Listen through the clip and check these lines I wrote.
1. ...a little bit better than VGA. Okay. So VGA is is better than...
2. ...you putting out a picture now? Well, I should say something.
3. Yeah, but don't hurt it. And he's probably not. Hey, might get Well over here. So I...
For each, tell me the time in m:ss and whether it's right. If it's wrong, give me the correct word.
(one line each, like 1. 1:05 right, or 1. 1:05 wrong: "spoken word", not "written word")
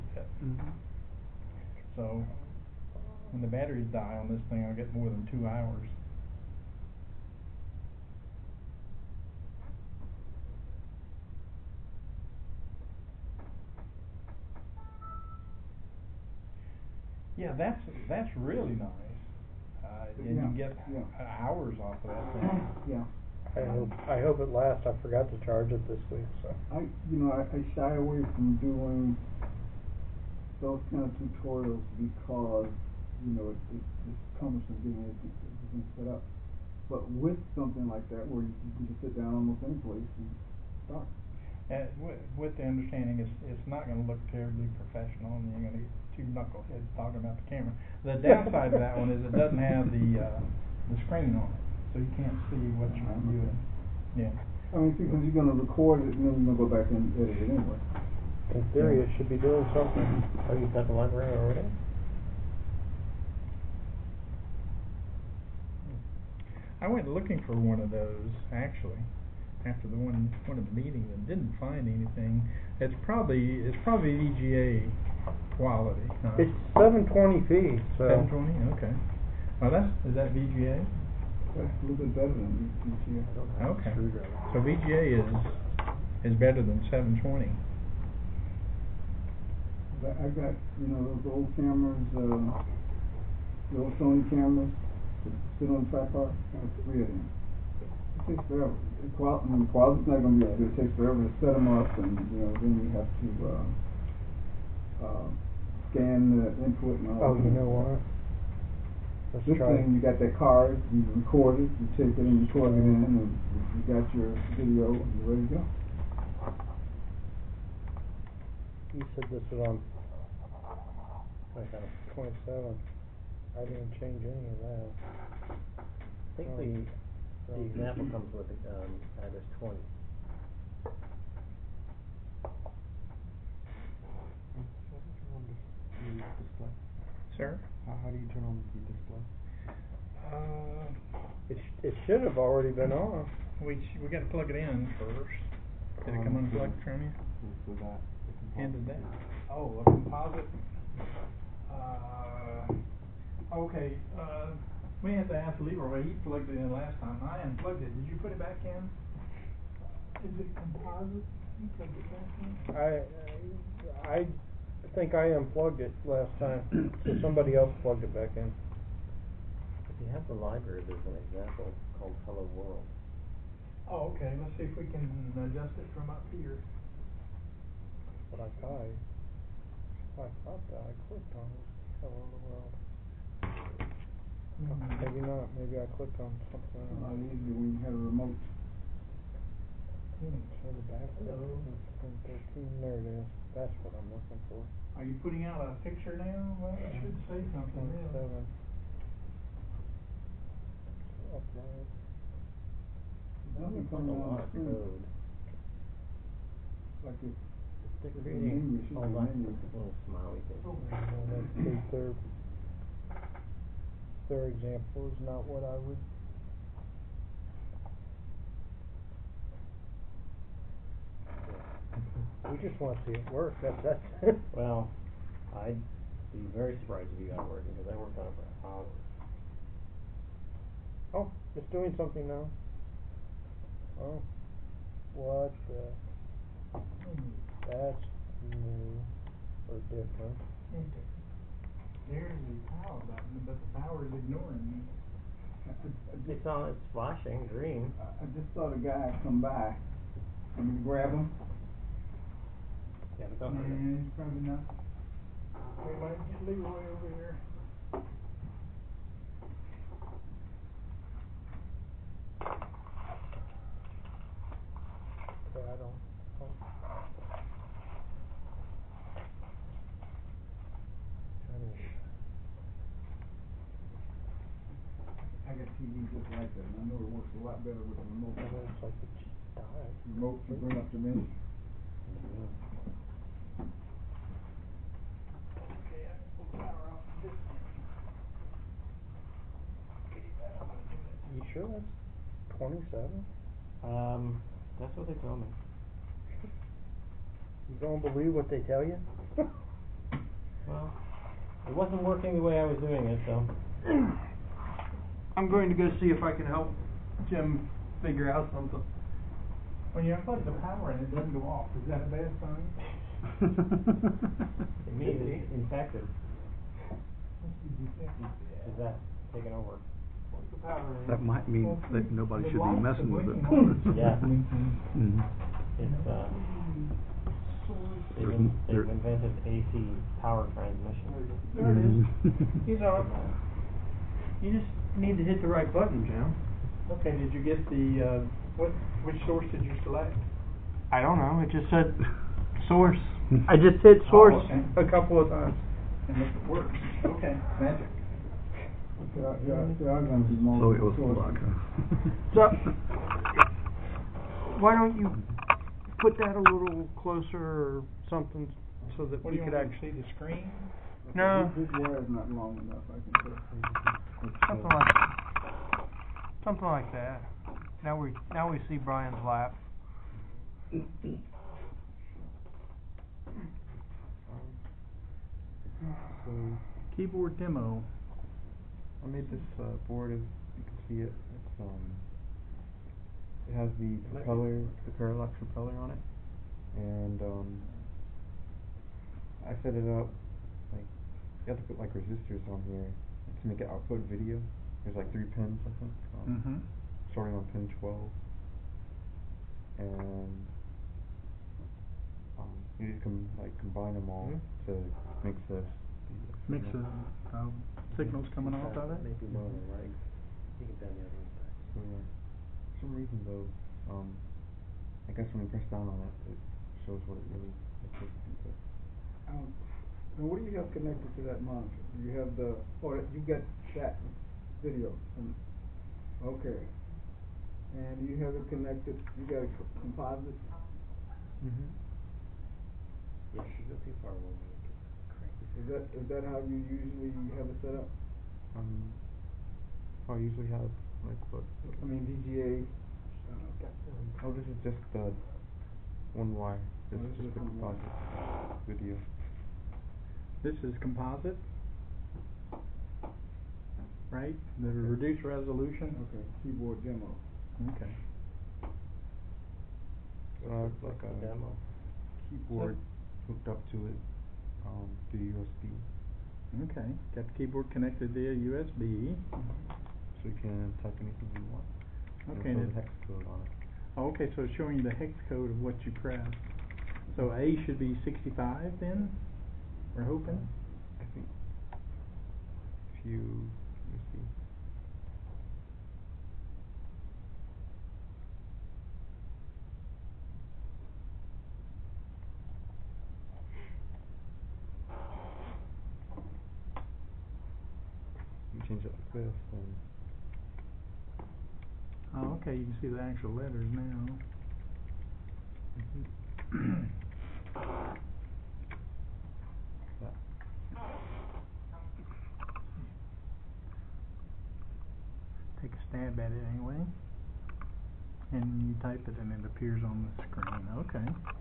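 1. 1:21 right
2. 3:15 right
3. 4:13 wrong: "Leroy", not "Well".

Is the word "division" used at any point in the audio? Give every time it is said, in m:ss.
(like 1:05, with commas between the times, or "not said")
not said.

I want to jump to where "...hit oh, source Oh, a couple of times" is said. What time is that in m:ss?
5:43.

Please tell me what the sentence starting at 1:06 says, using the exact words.
I went looking for one of those, actually after the one one of the meetings and didn't find anything.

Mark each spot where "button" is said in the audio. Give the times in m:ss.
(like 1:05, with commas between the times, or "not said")
4:02, 5:35.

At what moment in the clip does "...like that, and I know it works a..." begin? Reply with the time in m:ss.
4:36.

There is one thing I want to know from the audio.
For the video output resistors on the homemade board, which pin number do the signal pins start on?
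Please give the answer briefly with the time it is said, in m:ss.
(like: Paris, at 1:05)
12, at 6:37.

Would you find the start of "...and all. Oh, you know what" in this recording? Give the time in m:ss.
1:47.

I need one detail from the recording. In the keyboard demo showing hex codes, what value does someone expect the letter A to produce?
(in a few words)
65.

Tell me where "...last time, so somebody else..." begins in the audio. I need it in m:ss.
2:46.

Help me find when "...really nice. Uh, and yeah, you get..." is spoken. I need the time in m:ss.
0:18.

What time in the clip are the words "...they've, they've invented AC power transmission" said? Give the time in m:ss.
5:28.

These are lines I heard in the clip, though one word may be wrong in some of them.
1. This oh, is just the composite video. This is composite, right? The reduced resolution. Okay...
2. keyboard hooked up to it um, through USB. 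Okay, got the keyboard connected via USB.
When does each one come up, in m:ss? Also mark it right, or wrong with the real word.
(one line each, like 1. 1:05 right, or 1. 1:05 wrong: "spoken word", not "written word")
1. 7:26 right
2. 7:42 right.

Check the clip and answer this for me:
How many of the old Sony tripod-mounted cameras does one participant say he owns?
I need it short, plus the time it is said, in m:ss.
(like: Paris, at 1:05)
3, at 1:36.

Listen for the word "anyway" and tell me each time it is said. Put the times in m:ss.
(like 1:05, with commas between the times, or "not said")
0:57, 8:36.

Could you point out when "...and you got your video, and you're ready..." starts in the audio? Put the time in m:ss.
1:52.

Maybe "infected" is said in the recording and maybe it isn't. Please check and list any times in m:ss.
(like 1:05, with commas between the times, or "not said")
5:15.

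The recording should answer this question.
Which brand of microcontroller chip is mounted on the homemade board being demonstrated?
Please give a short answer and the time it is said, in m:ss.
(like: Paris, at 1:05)
Parallax Propeller, at 6:24.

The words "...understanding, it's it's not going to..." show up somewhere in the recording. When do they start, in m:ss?
0:42.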